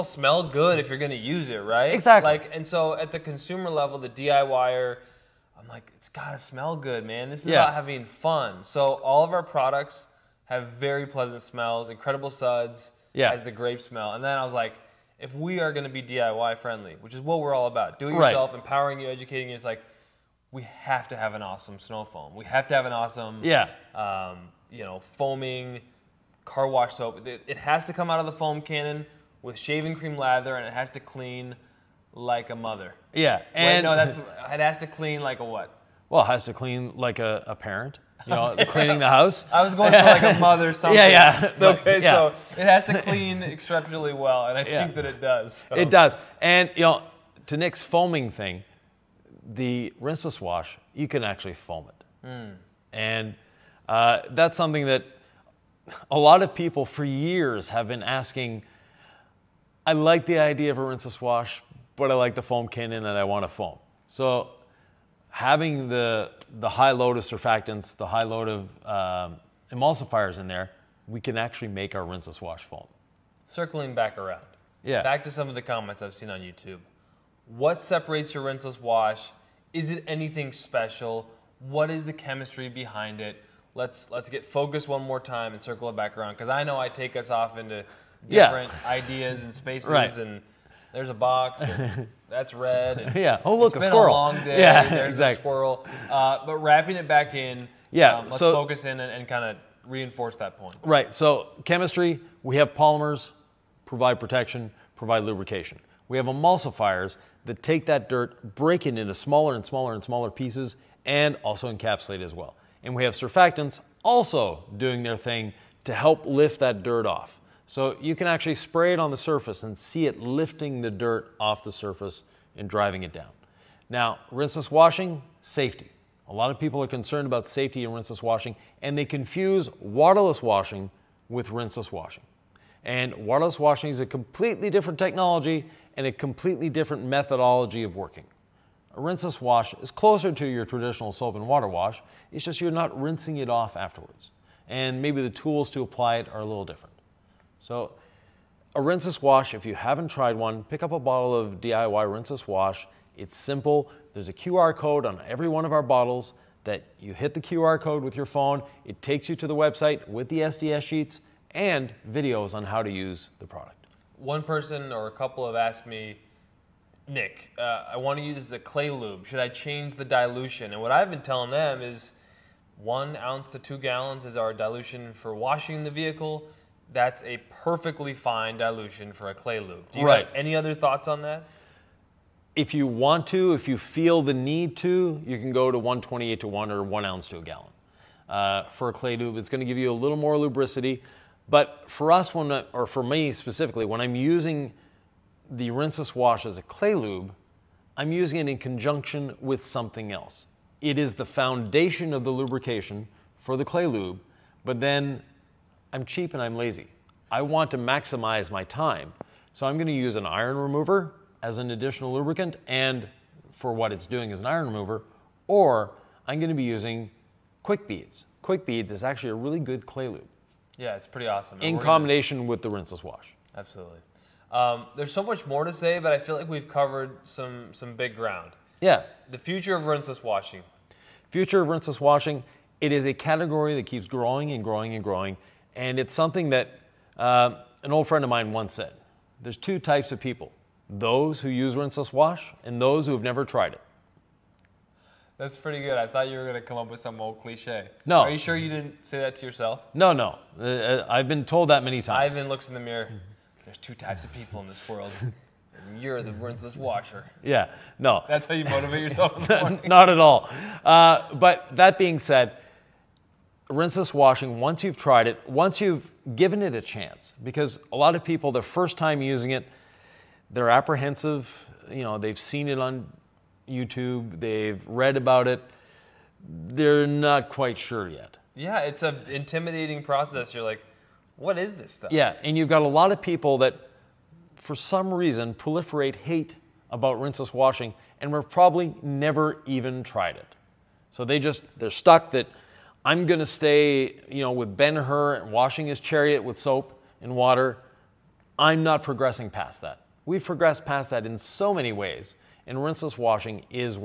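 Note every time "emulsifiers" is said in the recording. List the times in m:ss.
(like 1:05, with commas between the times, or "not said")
1:09, 1:46.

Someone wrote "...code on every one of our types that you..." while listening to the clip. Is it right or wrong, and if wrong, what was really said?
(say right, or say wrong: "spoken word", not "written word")
wrong: "bottles", not "types".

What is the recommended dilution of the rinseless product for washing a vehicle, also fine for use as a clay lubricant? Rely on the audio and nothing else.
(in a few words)
1 ounce to 2 gallons.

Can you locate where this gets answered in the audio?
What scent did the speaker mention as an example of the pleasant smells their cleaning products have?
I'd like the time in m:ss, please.
0:13.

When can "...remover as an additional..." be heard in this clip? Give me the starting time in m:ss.
3:30.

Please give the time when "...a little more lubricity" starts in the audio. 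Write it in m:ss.
3:09.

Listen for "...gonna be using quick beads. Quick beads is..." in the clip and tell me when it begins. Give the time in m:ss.
3:36.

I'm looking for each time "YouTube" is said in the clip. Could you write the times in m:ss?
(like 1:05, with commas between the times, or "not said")
1:16, 4:33.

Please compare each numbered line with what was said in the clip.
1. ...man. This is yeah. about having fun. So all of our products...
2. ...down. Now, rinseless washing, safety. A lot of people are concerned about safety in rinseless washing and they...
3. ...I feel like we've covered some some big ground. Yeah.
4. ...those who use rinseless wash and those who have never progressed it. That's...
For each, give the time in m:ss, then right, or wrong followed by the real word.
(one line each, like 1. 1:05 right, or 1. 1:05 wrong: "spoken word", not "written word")
1. 0:07 right
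2. 2:03 right
3. 3:46 right
4. 4:00 wrong: "tried", not "progressed".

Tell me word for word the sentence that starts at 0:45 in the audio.
It does, and you know, to Nick's foaming thing, the rinseless wash you can actually foam it, mm.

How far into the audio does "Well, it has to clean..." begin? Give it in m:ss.
0:36.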